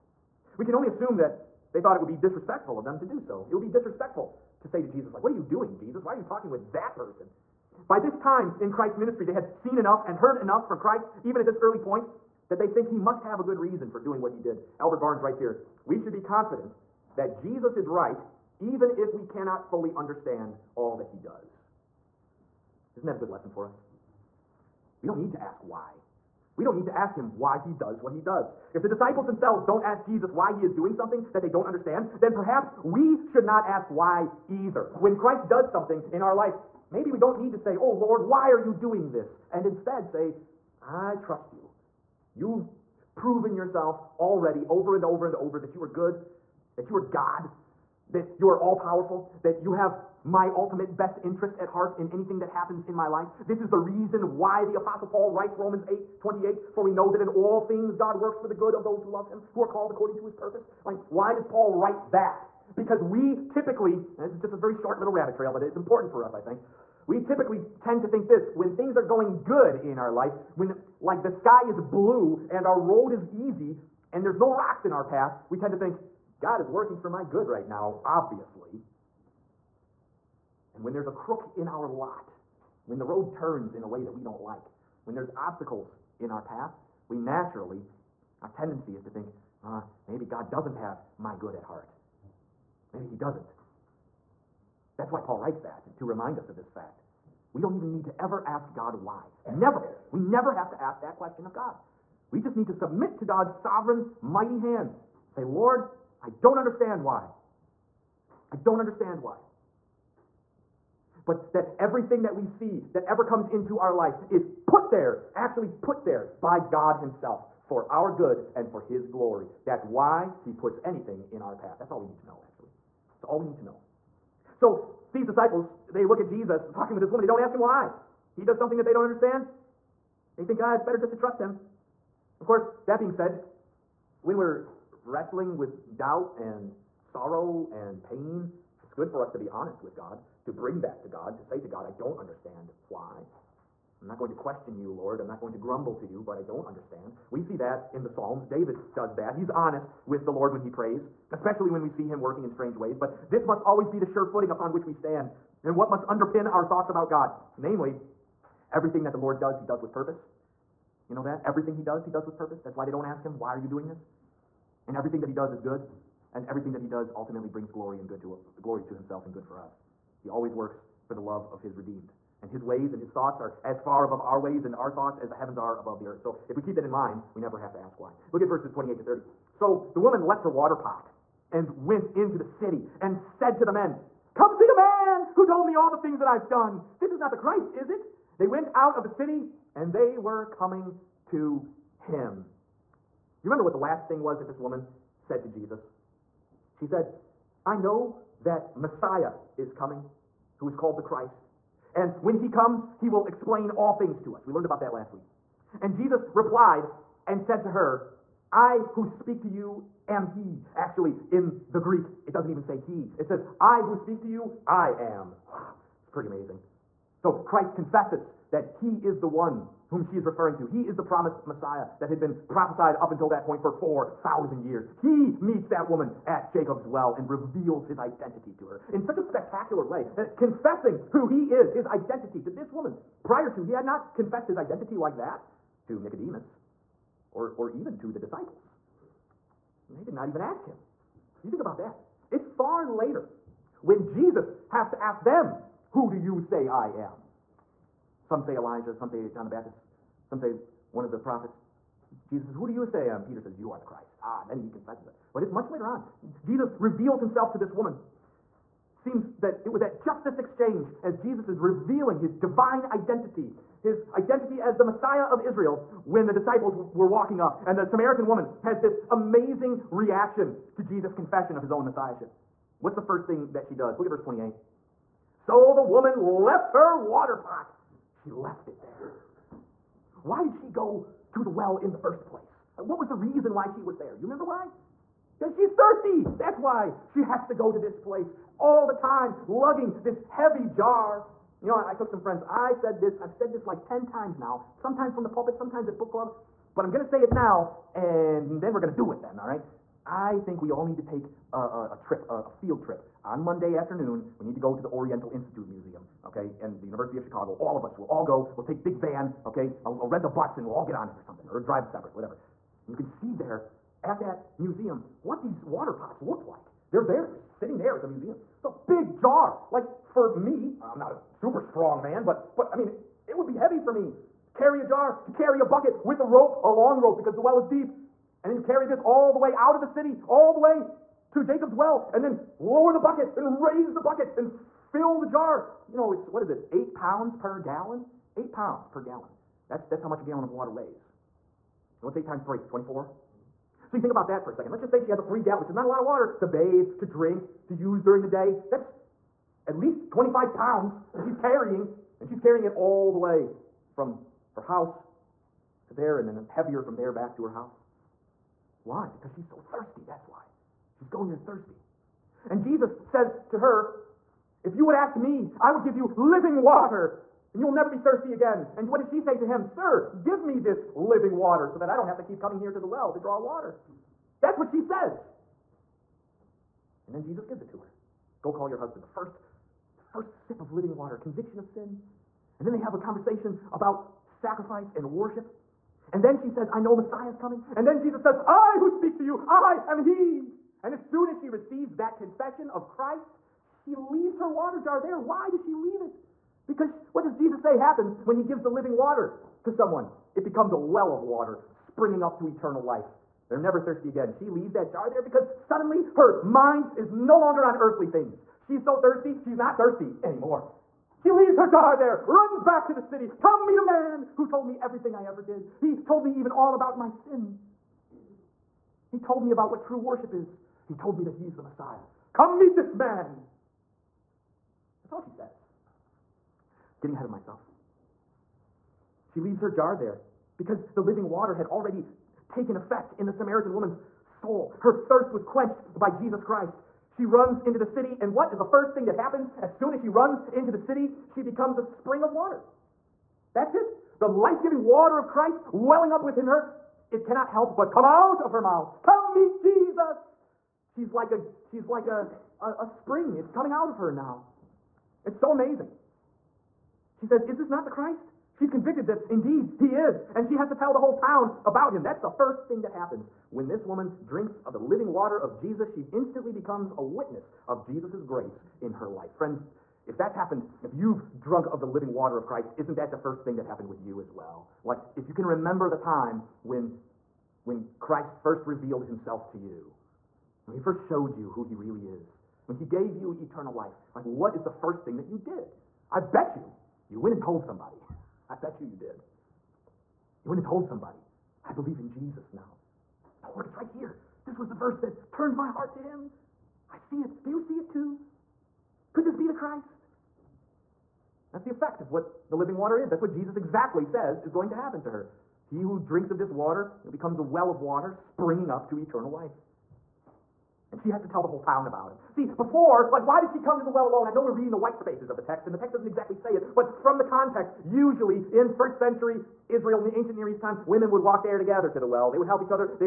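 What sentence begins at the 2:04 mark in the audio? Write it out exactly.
So these disciples, they look at Jesus talking with this woman.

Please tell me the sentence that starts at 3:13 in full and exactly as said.
You remember what the last thing was that this woman said to Jesus?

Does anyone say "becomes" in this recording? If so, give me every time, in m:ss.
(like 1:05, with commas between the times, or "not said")
6:40, 7:21, 7:46, 8:27.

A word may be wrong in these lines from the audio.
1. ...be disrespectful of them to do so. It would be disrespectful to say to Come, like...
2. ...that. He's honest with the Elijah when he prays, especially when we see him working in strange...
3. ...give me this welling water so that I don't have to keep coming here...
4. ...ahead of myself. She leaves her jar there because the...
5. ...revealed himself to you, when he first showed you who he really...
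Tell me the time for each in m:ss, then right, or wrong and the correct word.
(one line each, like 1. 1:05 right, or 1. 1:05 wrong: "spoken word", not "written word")
1. 0:02 wrong: "Jesus", not "Come"
2. 2:29 wrong: "Lord", not "Elijah"
3. 6:10 wrong: "living", not "welling"
4. 7:07 right
5. 7:58 right.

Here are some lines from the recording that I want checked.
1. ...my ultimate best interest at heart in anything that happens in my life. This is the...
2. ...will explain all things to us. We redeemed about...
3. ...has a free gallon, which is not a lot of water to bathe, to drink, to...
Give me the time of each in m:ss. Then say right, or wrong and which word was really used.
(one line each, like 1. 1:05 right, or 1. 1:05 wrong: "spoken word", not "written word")
1. 0:50 right
2. 3:23 wrong: "learned", not "redeemed"
3. 5:45 right.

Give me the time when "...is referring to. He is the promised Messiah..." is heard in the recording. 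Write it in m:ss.
3:40.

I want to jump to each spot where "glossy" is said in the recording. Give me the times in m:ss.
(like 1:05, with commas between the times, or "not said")
not said.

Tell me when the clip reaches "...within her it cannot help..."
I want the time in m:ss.
7:26.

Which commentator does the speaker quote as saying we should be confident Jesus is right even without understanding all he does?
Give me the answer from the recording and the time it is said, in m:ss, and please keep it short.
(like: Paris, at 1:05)
Albert Barnes, at 0:14.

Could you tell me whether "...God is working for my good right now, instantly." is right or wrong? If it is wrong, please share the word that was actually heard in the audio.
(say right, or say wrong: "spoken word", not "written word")
wrong: "obviously", not "instantly".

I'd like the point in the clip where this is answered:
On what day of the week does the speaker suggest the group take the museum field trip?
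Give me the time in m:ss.
5:03.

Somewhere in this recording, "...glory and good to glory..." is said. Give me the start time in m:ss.
2:47.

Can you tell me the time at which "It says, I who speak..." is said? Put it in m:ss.
3:33.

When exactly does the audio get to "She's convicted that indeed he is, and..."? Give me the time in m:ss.
7:38.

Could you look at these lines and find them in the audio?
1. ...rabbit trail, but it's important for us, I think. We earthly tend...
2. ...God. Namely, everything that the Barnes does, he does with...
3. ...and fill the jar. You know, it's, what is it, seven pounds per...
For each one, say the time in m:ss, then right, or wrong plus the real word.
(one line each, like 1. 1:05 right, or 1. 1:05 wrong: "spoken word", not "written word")
1. 1:05 wrong: "typically", not "earthly"
2. 2:37 wrong: "Lord", not "Barnes"
3. 5:34 wrong: "eight", not "seven".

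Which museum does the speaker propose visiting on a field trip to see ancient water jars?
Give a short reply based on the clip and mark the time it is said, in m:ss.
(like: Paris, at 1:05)
Oriental Institute Museum, at 5:04.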